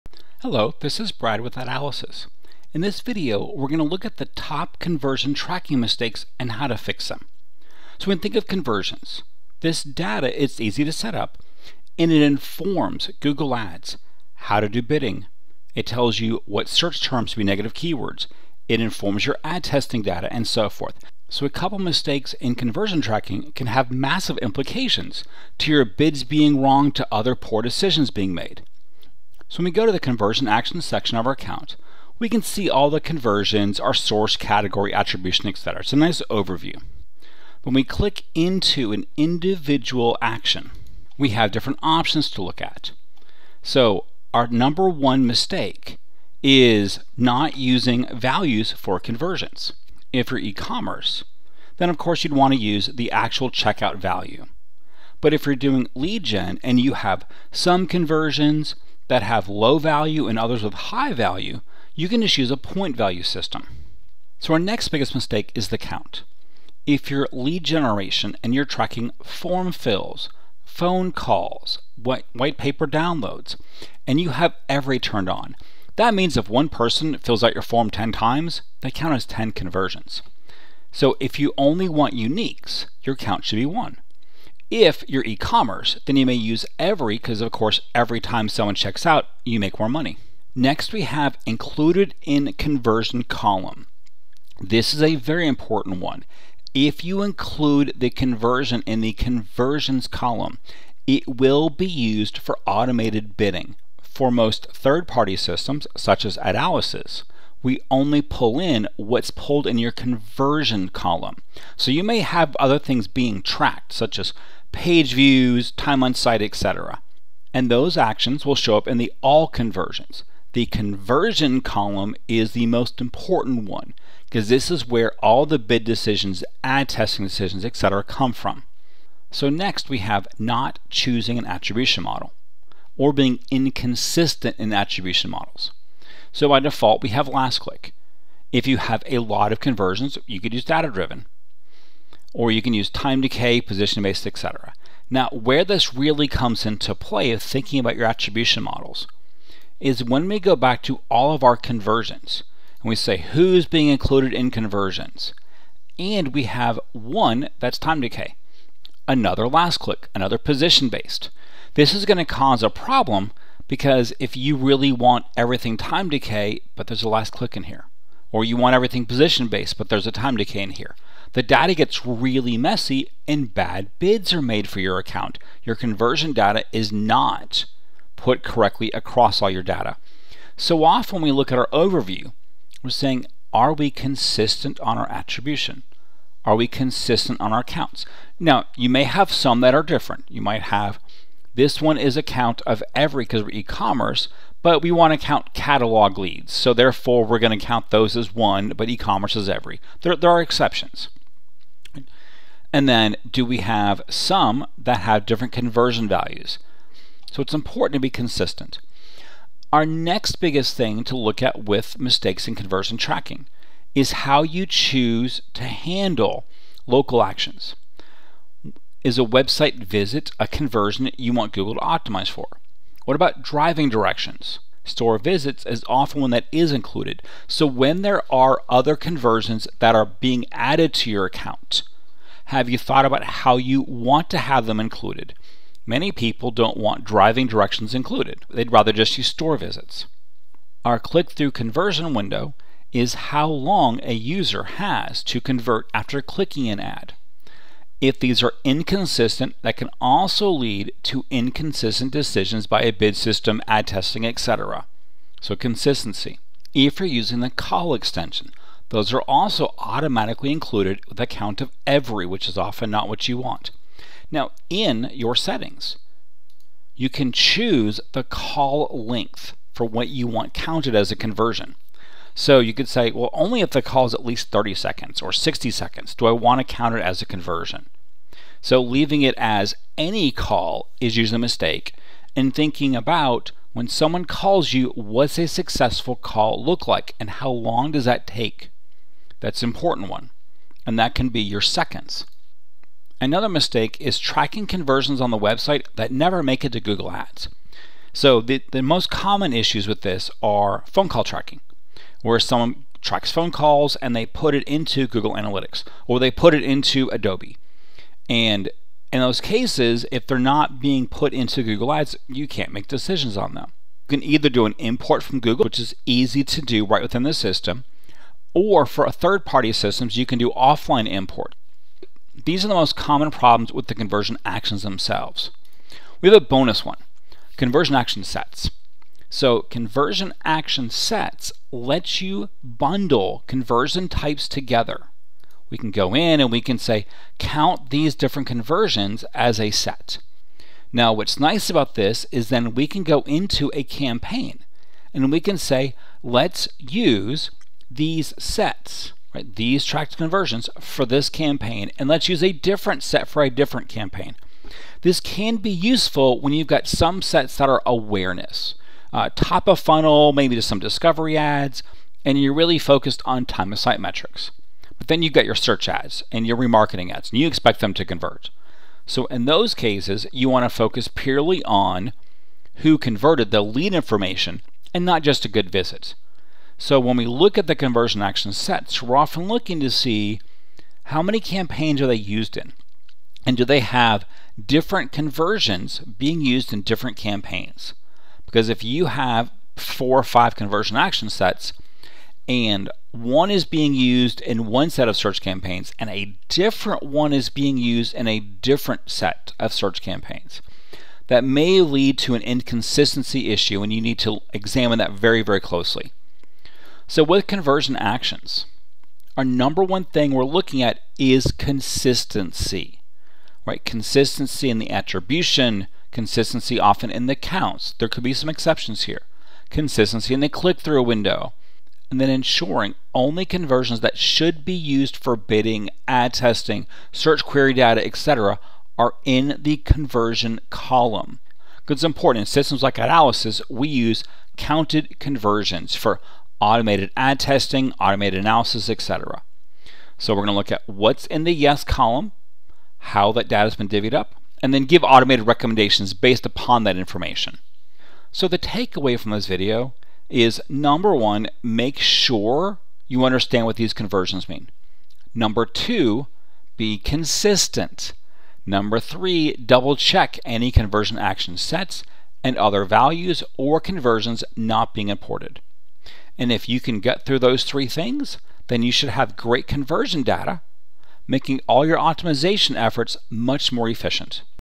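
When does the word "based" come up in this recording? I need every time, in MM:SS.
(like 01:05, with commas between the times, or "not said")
02:24, 02:40, 02:49, 07:26.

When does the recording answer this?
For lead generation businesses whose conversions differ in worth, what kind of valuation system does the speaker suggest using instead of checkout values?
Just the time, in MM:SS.
01:02.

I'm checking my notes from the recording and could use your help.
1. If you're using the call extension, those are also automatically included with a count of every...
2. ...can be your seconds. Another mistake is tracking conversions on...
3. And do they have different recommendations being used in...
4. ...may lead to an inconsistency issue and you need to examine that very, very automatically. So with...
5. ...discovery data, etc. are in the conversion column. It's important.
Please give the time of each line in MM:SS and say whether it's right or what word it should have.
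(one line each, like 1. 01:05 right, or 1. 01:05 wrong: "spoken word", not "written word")
1. 04:16 right
2. 04:51 right
3. 06:23 wrong: "conversions", not "recommendations"
4. 06:41 wrong: "closely", not "automatically"
5. 07:07 wrong: "query", not "discovery".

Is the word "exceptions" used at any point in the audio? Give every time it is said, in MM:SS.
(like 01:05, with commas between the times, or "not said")
03:20, 06:58.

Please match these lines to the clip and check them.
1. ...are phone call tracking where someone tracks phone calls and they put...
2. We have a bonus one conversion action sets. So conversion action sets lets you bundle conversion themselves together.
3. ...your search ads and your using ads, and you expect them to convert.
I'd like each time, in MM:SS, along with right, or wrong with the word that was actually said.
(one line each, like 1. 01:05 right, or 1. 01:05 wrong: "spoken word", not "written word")
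1. 05:00 right
2. 05:26 wrong: "types", not "themselves"
3. 06:05 wrong: "remarketing", not "using".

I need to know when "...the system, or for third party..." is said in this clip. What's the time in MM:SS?
05:17.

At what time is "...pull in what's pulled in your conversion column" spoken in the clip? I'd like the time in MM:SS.
01:48.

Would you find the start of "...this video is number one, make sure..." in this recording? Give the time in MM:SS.
07:29.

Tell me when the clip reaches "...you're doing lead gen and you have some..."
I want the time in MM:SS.
00:55.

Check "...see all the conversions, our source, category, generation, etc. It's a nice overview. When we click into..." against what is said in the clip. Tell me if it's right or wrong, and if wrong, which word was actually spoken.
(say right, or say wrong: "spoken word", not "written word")
wrong: "attribution", not "generation".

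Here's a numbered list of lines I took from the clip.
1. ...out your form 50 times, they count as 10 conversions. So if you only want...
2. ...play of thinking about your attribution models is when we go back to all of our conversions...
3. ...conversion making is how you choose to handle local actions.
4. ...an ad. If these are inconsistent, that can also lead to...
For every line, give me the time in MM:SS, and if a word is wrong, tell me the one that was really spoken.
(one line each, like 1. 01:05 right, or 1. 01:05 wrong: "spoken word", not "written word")
1. 01:17 wrong: "10", not "50"
2. 02:26 right
3. 03:32 wrong: "tracking", not "making"
4. 04:06 right.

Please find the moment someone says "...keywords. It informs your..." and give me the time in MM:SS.
00:17.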